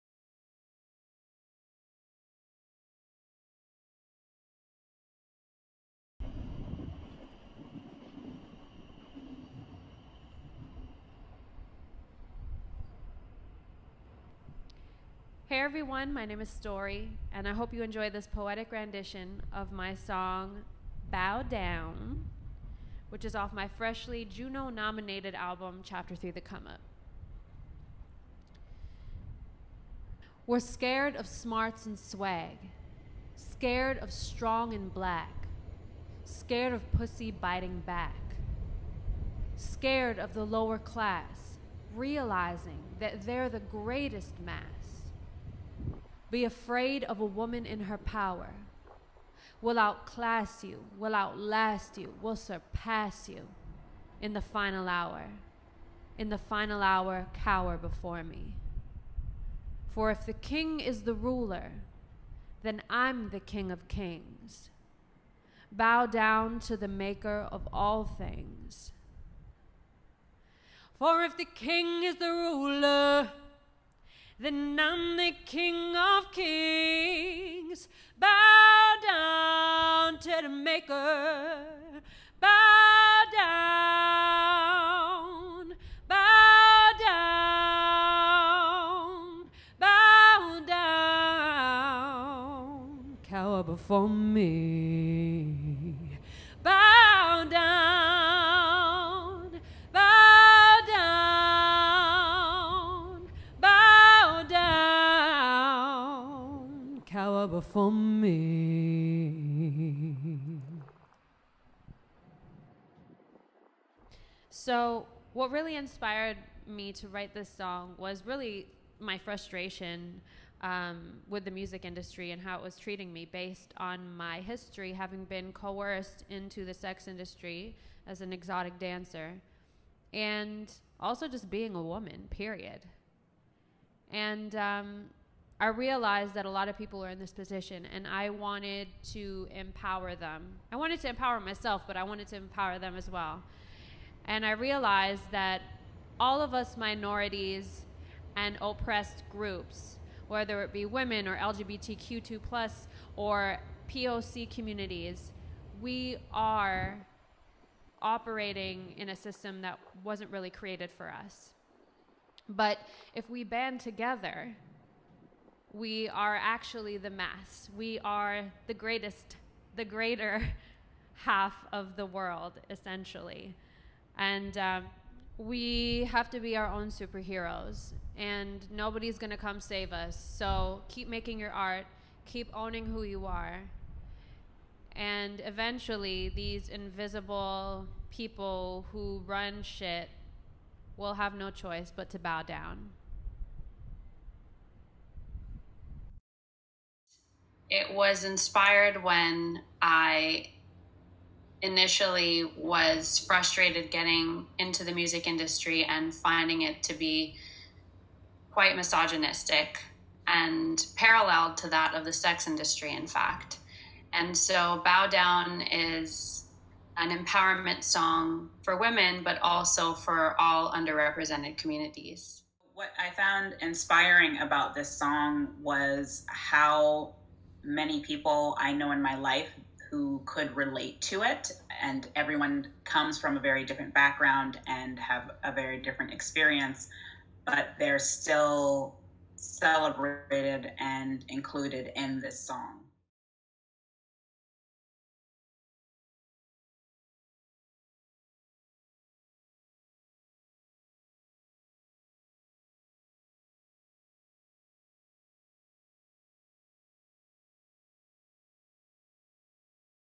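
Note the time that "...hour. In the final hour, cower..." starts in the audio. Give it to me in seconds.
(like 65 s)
54 s.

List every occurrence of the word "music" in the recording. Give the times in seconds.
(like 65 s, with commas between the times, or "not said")
121 s, 204 s.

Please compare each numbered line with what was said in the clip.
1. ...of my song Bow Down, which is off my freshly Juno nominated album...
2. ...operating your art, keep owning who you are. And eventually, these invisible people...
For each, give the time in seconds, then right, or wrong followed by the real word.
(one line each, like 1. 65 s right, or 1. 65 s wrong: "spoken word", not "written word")
1. 19 s right
2. 181 s wrong: "making", not "operating".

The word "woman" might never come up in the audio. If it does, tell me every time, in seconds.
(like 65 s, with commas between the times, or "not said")
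47 s, 131 s.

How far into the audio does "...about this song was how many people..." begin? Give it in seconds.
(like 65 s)
224 s.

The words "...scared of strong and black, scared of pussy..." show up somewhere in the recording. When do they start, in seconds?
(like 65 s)
33 s.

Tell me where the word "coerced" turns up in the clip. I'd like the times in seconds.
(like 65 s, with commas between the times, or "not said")
125 s.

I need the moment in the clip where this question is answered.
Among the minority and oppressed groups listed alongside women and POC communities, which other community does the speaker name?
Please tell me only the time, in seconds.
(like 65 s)
151 s.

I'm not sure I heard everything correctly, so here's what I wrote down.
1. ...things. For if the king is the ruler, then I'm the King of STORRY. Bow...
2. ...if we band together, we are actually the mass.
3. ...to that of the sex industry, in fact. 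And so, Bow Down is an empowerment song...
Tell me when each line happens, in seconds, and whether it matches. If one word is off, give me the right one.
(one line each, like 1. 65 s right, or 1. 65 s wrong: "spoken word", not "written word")
1. 68 s wrong: "Kings", not "STORRY"
2. 163 s right
3. 211 s right.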